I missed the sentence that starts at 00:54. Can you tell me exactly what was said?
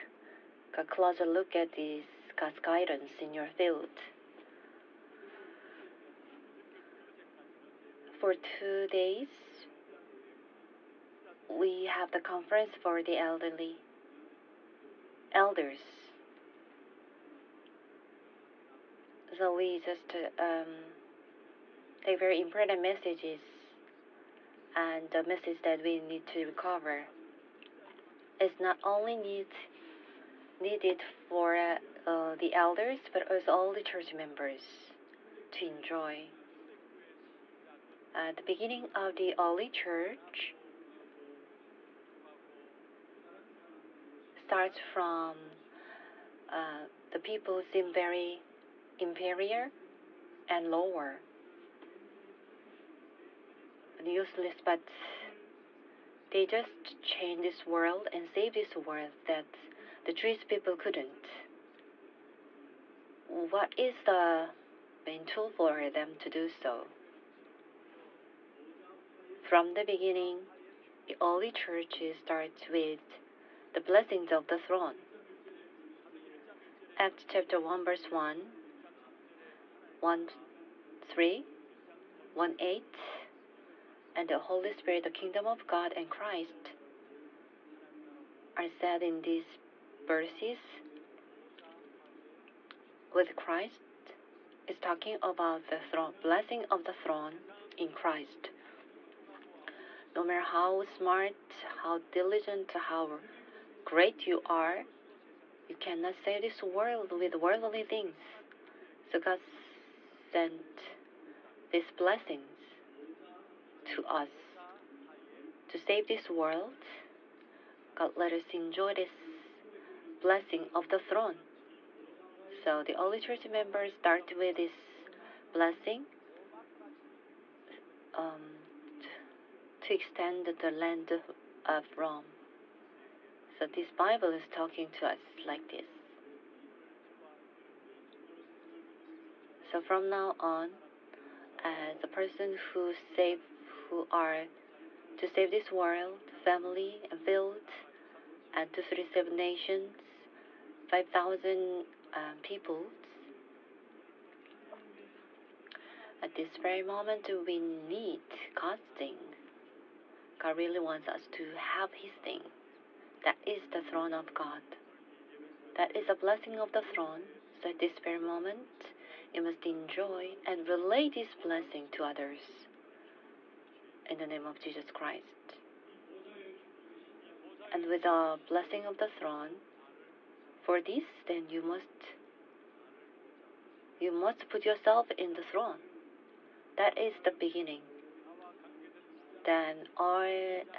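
useless, but they just change this world and save this world that the Jewish people couldn't.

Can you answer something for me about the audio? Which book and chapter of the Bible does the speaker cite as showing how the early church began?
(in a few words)
Acts chapter 1.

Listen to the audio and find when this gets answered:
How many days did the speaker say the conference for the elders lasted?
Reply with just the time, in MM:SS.
00:08.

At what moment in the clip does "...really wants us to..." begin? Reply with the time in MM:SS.
02:40.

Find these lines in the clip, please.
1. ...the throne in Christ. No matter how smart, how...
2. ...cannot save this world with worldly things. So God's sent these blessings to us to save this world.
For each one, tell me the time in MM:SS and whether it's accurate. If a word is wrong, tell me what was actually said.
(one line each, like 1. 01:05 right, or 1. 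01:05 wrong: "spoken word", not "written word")
1. 01:36 right
2. 01:45 right.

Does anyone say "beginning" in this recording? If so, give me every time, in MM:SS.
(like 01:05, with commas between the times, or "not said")
00:38, 01:09, 03:07.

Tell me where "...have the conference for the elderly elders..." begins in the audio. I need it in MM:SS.
00:11.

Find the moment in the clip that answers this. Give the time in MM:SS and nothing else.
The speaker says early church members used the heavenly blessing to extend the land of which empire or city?
02:11.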